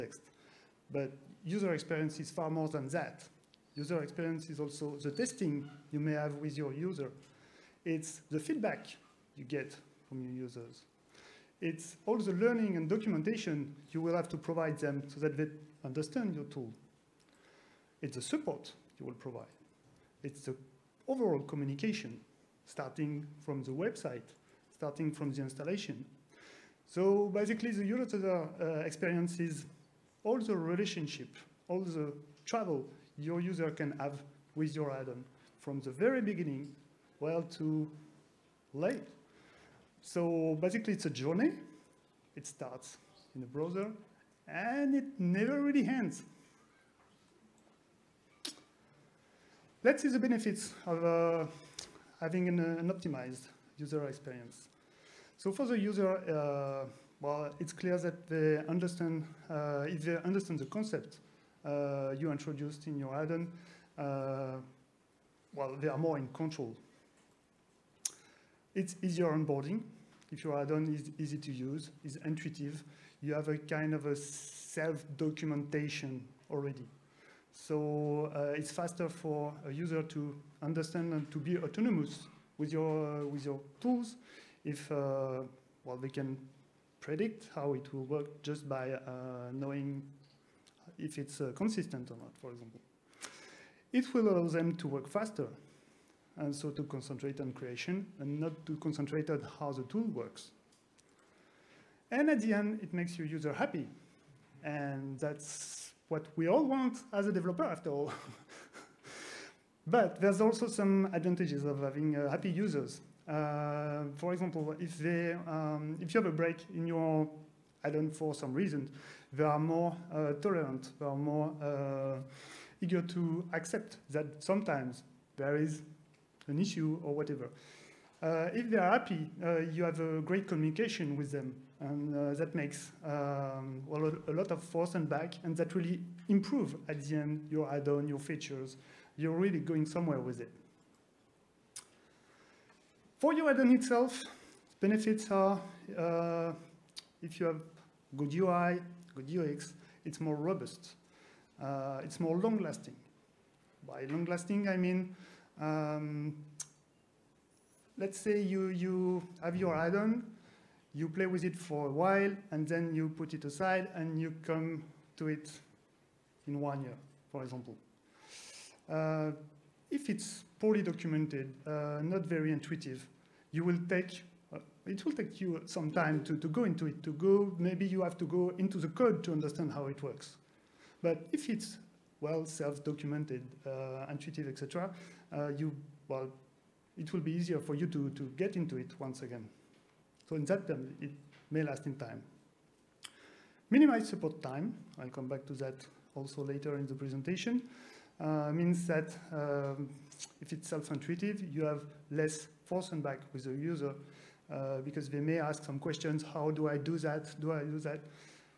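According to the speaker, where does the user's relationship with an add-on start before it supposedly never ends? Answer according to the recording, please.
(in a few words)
the browser.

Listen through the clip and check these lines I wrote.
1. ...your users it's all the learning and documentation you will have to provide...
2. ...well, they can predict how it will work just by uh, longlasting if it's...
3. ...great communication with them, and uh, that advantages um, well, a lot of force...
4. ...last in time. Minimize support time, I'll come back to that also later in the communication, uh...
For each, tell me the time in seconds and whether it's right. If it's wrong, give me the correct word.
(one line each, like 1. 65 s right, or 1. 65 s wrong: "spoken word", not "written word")
1. 10 s right
2. 85 s wrong: "knowing", not "longlasting"
3. 130 s wrong: "makes", not "advantages"
4. 191 s wrong: "presentation", not "communication".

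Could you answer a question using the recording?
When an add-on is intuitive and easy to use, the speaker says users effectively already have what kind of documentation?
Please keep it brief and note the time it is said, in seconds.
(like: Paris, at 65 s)
self-documentation, at 74 s.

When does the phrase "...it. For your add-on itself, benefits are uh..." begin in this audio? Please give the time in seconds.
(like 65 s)
140 s.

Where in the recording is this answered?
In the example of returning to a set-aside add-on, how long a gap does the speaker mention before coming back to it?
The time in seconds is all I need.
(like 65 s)
166 s.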